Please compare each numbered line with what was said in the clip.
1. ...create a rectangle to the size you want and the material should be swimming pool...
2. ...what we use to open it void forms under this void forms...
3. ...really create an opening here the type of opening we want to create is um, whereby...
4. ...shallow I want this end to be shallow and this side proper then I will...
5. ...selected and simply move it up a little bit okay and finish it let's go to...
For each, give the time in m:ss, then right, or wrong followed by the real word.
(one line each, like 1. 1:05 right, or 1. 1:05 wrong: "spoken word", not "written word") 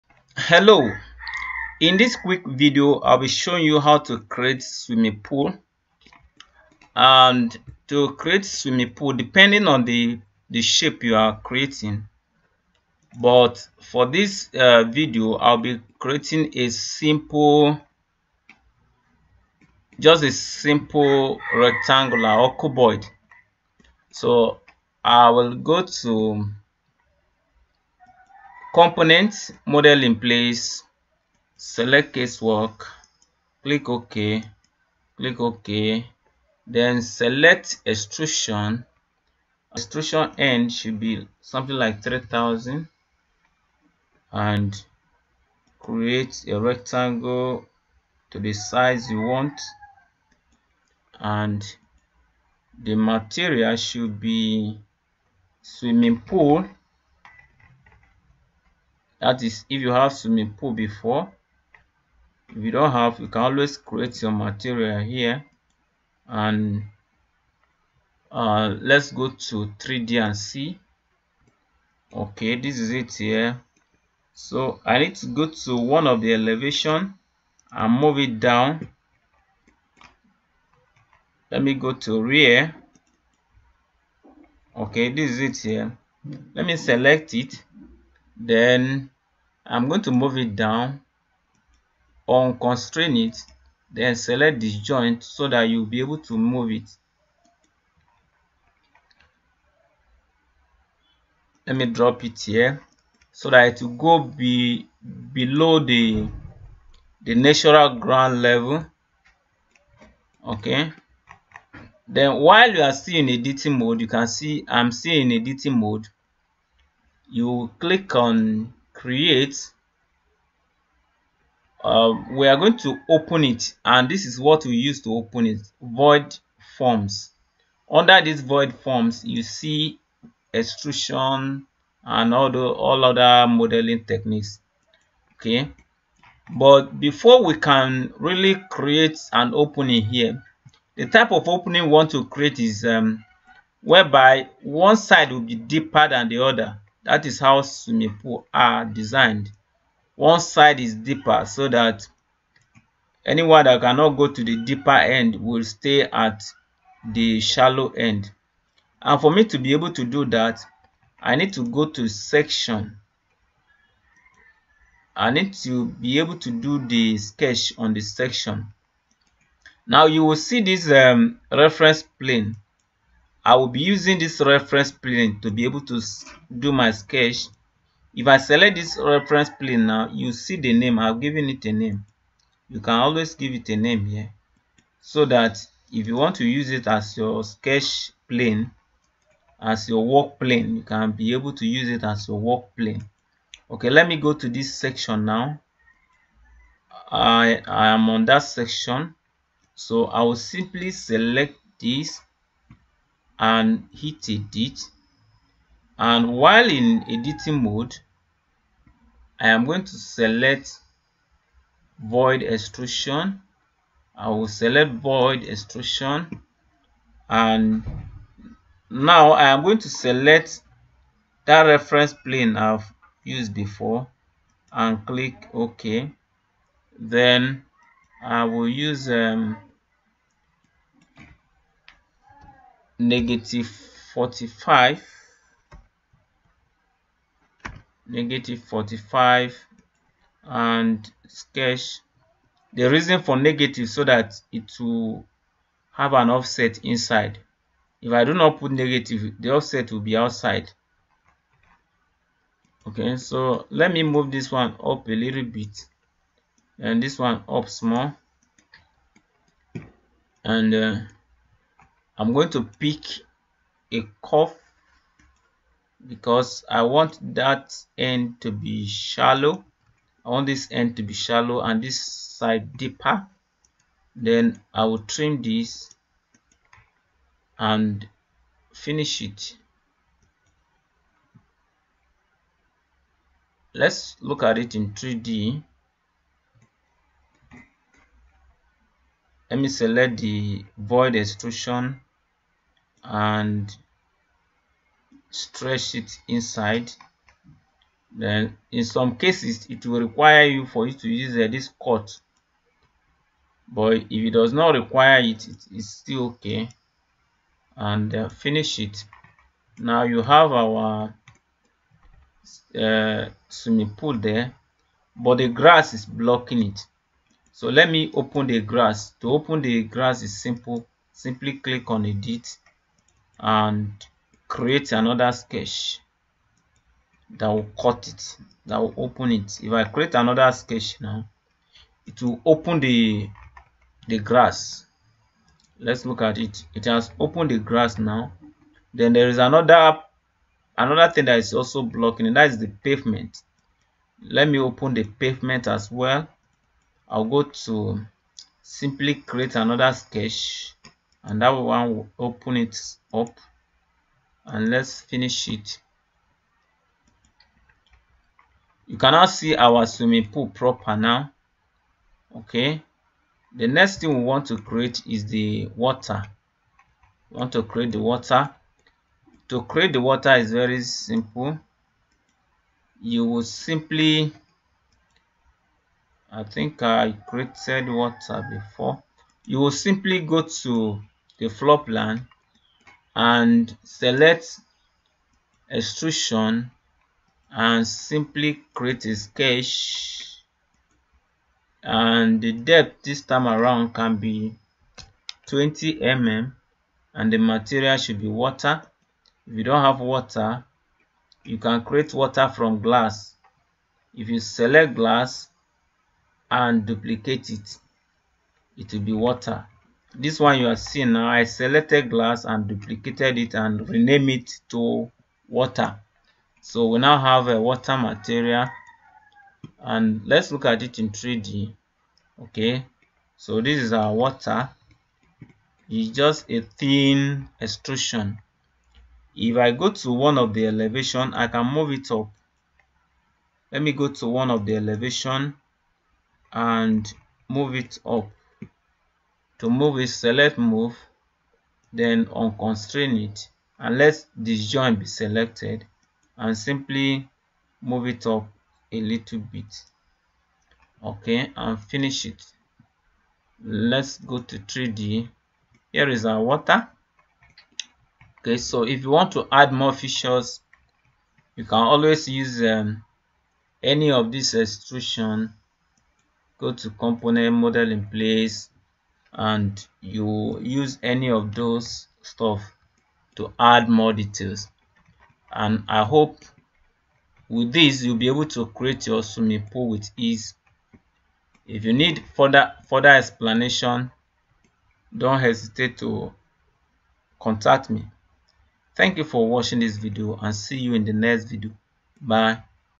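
1. 0:45 right
2. 2:04 right
3. 2:18 right
4. 4:28 wrong: "deeper", not "proper"
5. 7:25 right.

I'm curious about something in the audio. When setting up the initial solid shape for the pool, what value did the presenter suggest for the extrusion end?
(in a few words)
3000.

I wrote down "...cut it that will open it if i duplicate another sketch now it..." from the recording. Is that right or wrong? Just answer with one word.
wrong.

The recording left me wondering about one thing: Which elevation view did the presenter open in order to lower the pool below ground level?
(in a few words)
rear.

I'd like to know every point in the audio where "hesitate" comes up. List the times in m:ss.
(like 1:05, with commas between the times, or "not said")
8:05.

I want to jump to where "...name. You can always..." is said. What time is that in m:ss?
3:01.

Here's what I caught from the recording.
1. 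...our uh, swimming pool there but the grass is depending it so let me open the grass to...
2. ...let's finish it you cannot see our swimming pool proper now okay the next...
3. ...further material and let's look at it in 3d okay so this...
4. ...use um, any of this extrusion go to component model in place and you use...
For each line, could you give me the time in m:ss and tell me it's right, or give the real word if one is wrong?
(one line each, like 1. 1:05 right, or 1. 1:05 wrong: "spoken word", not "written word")
1. 5:10 wrong: "blocking", not "depending"
2. 5:54 right
3. 6:57 wrong: "water", not "further"
4. 7:42 right.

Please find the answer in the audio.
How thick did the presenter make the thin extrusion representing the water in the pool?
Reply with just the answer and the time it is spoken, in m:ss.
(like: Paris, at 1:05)
20 mm, at 6:35.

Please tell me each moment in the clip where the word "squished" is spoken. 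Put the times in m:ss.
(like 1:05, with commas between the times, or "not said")
not said.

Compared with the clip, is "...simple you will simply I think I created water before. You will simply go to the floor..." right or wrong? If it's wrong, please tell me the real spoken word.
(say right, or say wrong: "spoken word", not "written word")
right.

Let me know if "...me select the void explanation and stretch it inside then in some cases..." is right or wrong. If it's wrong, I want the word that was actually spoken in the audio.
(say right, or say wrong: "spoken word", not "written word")
wrong: "extrusion", not "explanation".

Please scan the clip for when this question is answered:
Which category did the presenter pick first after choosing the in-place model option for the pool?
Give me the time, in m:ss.
0:32.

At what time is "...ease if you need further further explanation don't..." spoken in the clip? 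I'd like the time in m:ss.
8:00.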